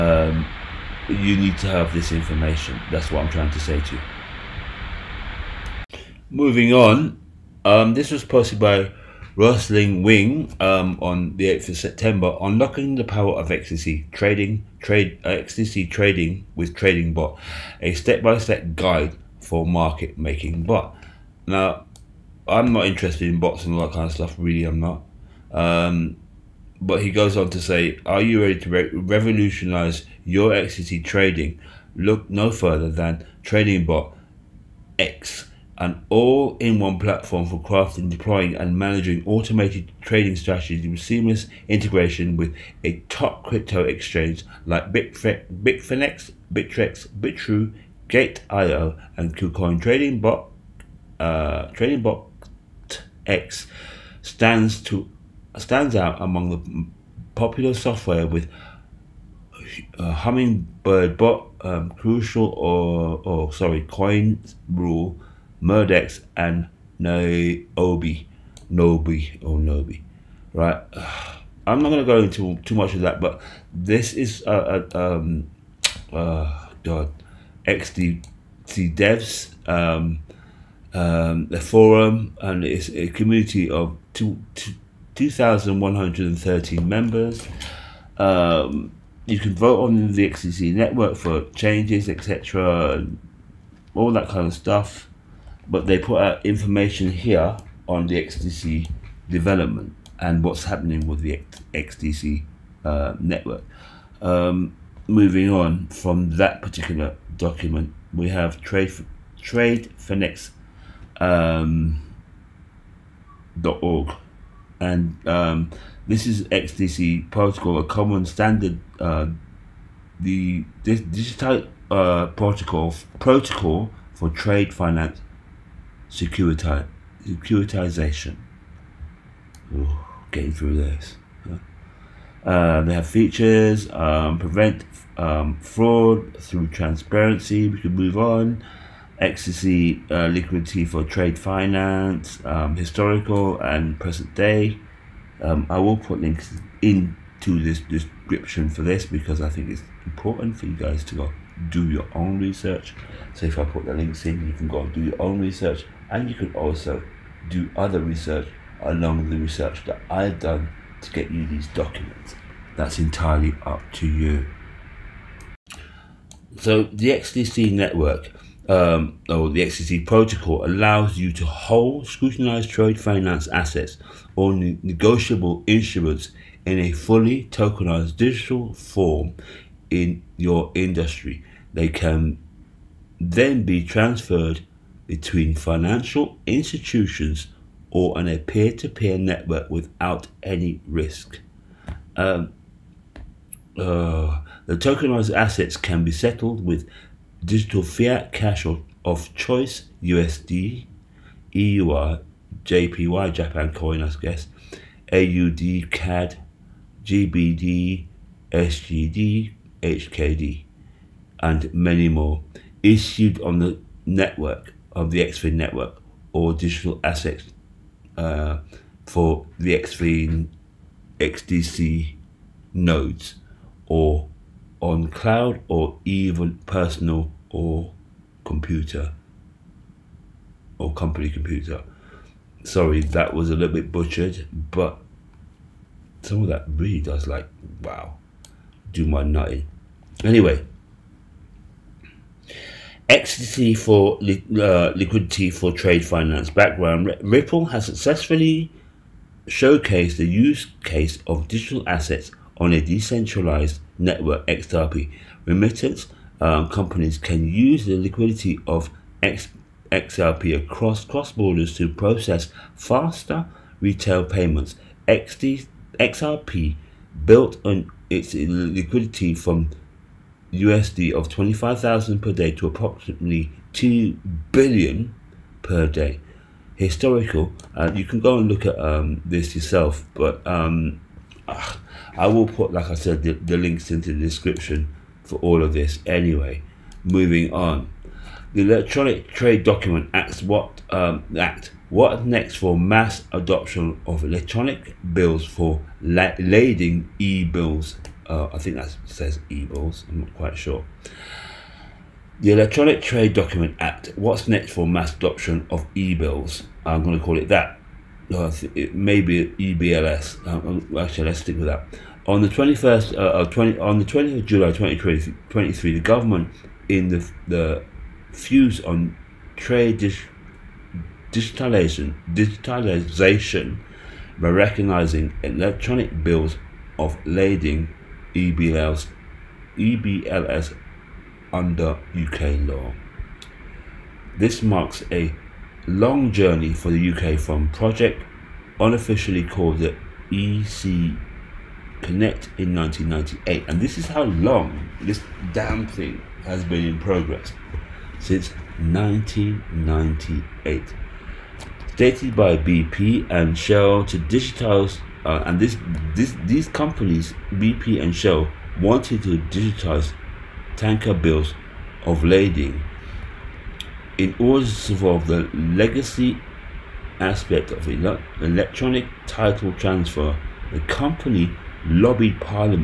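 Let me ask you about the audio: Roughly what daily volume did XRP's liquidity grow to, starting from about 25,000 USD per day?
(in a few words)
2 billion per day.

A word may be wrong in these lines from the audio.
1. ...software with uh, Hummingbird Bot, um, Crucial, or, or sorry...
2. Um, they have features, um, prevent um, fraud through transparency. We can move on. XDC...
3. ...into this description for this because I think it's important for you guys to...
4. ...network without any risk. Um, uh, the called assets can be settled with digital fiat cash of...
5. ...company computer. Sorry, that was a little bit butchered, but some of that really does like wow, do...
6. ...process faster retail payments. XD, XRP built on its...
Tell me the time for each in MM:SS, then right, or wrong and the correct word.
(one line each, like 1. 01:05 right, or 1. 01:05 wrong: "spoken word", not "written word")
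1. 00:57 right
2. 02:12 right
3. 02:26 right
4. 03:09 wrong: "tokenized", not "called"
5. 03:50 right
6. 04:21 right.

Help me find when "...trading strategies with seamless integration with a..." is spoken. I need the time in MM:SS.
00:40.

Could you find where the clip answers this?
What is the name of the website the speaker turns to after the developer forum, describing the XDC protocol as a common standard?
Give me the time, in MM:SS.
01:49.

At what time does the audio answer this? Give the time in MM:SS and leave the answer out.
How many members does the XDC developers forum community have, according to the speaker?
01:25.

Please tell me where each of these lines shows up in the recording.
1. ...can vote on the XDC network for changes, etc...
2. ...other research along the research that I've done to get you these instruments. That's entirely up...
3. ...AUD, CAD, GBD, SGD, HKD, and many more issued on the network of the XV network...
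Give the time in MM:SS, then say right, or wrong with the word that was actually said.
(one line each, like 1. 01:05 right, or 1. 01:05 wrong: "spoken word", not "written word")
1. 01:29 right
2. 02:37 wrong: "documents", not "instruments"
3. 03:25 right.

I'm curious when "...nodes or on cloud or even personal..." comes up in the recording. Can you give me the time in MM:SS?
03:42.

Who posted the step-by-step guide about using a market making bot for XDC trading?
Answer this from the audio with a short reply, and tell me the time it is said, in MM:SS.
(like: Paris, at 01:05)
Rustling Wing, at 00:09.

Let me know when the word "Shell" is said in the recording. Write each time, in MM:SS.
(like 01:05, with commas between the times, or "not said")
05:53, 05:58.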